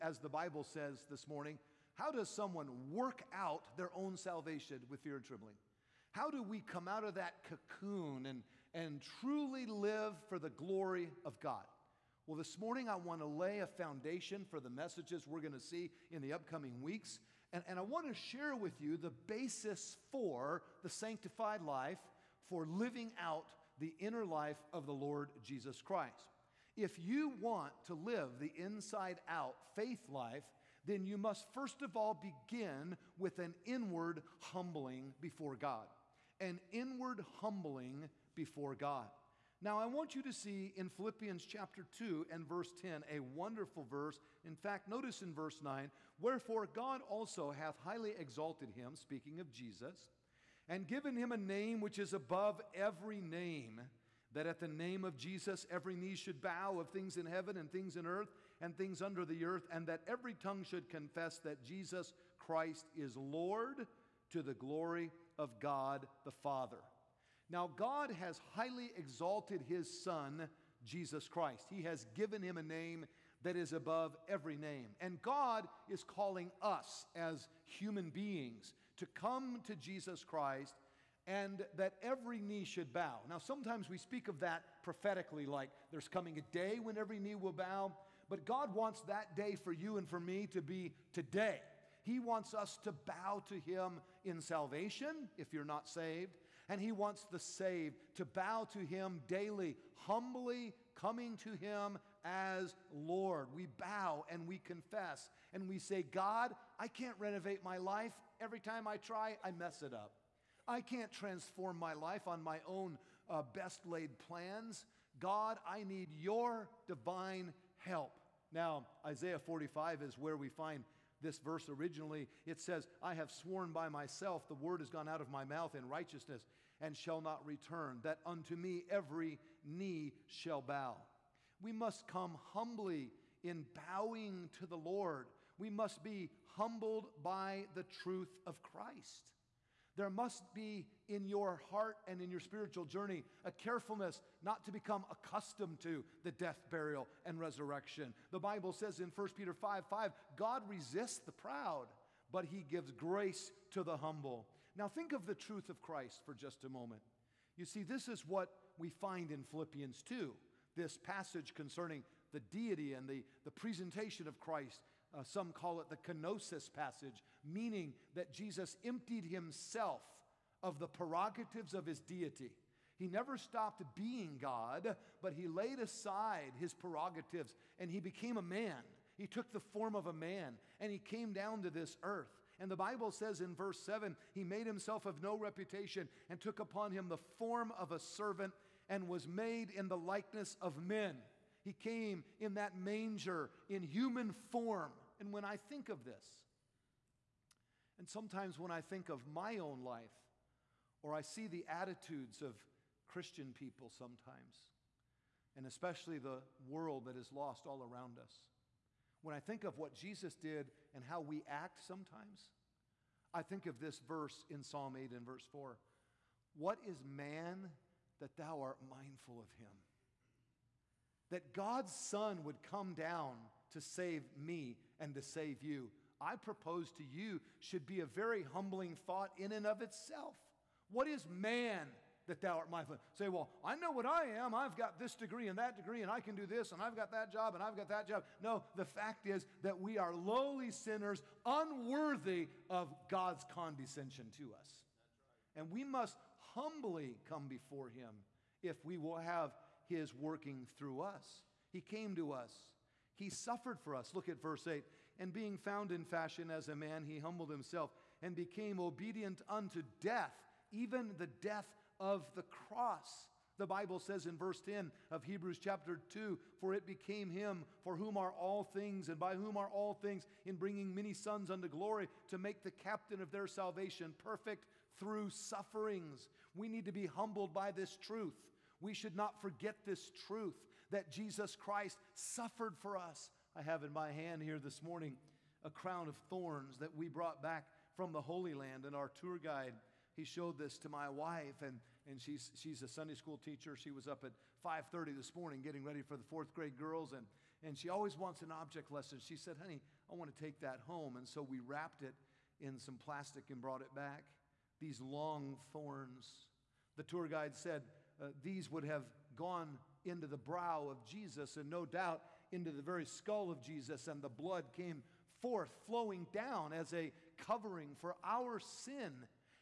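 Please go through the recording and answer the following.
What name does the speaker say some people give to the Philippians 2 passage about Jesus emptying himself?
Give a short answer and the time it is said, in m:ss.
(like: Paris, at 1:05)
kenosis passage, at 2:45.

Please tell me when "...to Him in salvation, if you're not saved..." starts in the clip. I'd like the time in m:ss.
1:33.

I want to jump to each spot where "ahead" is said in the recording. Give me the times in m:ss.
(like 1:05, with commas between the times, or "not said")
not said.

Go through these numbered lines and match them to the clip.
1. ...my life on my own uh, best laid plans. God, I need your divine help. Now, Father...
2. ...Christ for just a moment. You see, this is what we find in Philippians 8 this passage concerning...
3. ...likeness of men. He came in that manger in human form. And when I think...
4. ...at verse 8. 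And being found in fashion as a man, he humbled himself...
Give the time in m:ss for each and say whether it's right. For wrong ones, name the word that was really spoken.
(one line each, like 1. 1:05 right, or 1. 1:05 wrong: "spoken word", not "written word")
1. 1:51 wrong: "Isaiah", not "Father"
2. 2:35 wrong: "2", not "8"
3. 3:09 right
4. 4:14 right.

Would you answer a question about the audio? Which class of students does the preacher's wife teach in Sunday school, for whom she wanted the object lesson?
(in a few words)
fourth grade girls.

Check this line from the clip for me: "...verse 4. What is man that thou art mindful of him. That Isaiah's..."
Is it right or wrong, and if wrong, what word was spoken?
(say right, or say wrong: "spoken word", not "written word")
wrong: "God", not "Isaiah".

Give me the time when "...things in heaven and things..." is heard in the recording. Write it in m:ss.
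0:56.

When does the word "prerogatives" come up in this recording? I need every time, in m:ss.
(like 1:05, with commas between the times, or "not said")
2:50, 2:56.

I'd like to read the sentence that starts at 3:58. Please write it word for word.
No, the fact is that we are lowly sinners, unworthy of God's condescension to us.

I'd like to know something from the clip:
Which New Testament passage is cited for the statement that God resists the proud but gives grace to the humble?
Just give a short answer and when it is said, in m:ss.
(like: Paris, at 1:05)
1 Peter 5:5, at 2:29.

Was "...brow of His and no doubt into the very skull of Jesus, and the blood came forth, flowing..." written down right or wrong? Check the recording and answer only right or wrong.
wrong.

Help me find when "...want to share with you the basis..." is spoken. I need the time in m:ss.
0:17.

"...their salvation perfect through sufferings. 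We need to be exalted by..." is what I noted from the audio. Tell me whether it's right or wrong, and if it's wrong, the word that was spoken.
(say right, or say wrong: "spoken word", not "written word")
wrong: "humbled", not "exalted".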